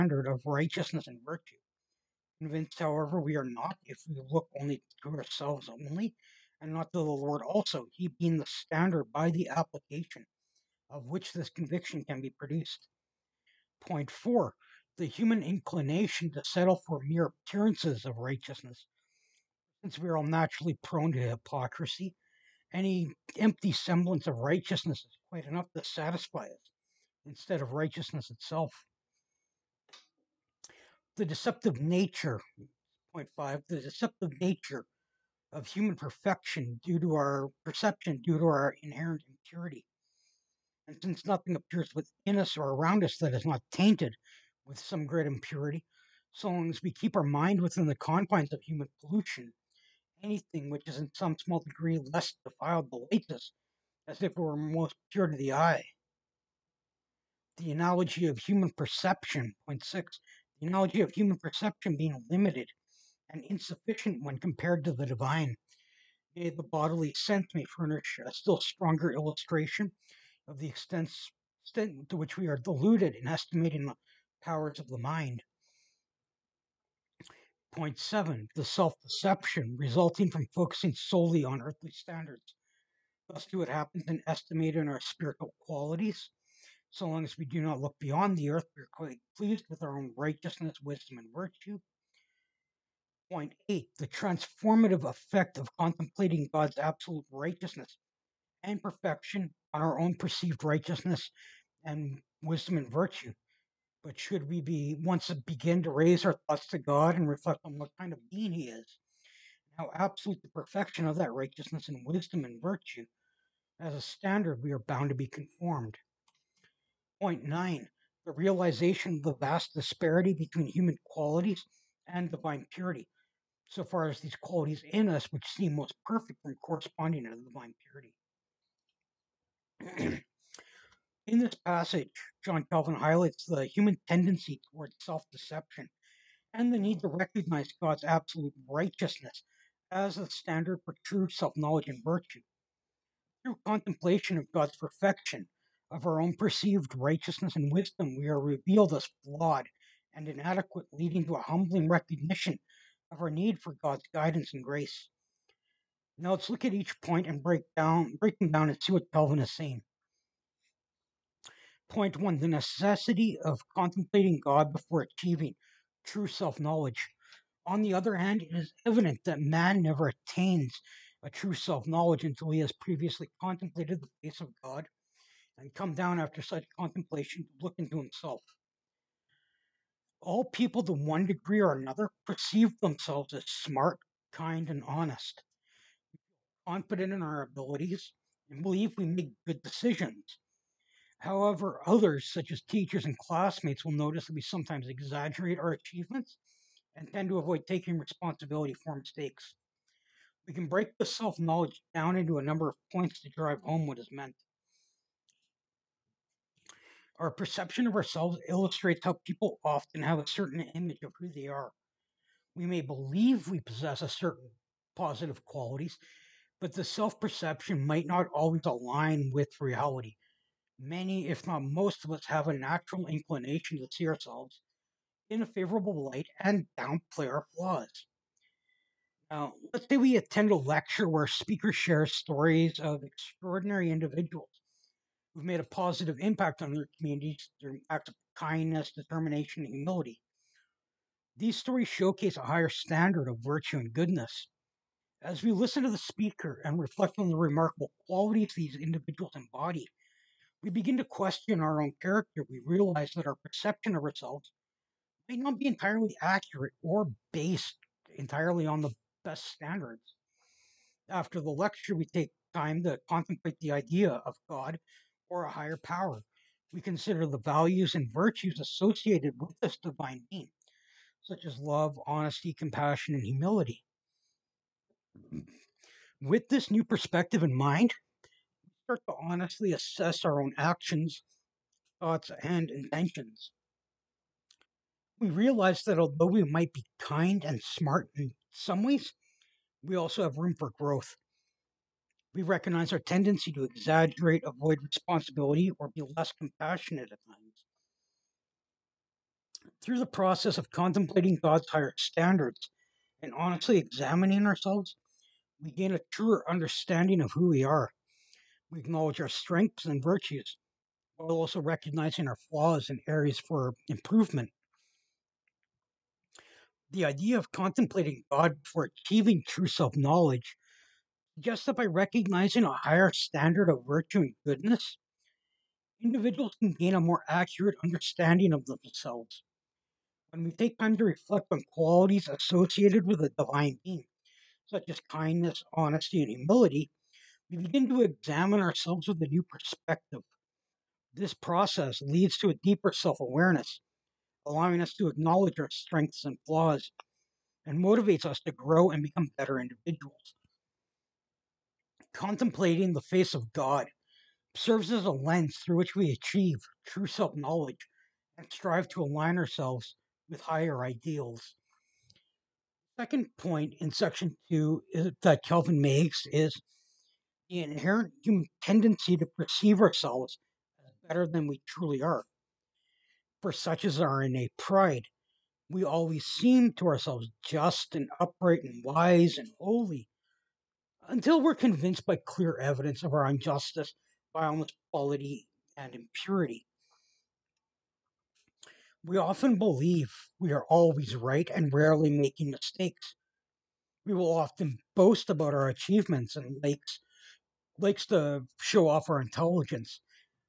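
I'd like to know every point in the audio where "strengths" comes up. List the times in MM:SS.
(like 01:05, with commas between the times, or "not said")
05:09, 05:45.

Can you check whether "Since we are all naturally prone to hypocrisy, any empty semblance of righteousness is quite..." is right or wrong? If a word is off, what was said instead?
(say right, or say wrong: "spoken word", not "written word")
right.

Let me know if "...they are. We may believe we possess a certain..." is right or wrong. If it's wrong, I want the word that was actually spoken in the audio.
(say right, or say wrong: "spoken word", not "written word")
right.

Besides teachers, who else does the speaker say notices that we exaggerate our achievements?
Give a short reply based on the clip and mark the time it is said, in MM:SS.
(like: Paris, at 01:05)
classmates, at 03:13.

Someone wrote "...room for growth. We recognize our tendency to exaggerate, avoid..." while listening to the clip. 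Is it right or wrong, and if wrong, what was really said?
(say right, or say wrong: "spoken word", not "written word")
right.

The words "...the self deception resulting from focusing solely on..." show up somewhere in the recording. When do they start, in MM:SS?
01:18.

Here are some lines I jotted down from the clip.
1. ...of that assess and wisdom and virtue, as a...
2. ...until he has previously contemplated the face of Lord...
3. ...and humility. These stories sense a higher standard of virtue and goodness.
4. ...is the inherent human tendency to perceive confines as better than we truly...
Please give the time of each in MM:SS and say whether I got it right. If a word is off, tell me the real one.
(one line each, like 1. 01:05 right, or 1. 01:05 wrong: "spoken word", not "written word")
1. 01:51 wrong: "righteousness", not "assess"
2. 02:52 wrong: "God", not "Lord"
3. 03:59 wrong: "showcase", not "sense"
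4. 06:06 wrong: "ourselves", not "confines".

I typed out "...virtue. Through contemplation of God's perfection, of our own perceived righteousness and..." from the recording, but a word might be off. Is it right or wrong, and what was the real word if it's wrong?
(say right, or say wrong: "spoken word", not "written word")
right.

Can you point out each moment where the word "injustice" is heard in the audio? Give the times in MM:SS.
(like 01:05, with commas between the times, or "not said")
06:23.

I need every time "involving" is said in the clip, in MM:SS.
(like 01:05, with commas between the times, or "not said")
not said.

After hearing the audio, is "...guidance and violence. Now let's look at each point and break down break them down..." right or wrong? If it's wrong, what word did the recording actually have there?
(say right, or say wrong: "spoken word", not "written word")
wrong: "grace", not "violence".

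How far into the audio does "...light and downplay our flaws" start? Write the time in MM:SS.
03:46.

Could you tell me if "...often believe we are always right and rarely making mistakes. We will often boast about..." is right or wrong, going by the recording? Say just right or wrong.
right.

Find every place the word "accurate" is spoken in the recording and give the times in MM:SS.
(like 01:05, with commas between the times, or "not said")
04:16, 05:27.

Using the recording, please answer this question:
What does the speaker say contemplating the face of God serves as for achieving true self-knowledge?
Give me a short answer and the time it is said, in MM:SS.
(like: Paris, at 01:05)
a lens, at 05:55.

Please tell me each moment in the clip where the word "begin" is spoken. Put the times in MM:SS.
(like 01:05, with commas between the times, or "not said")
01:45, 04:10, 05:37.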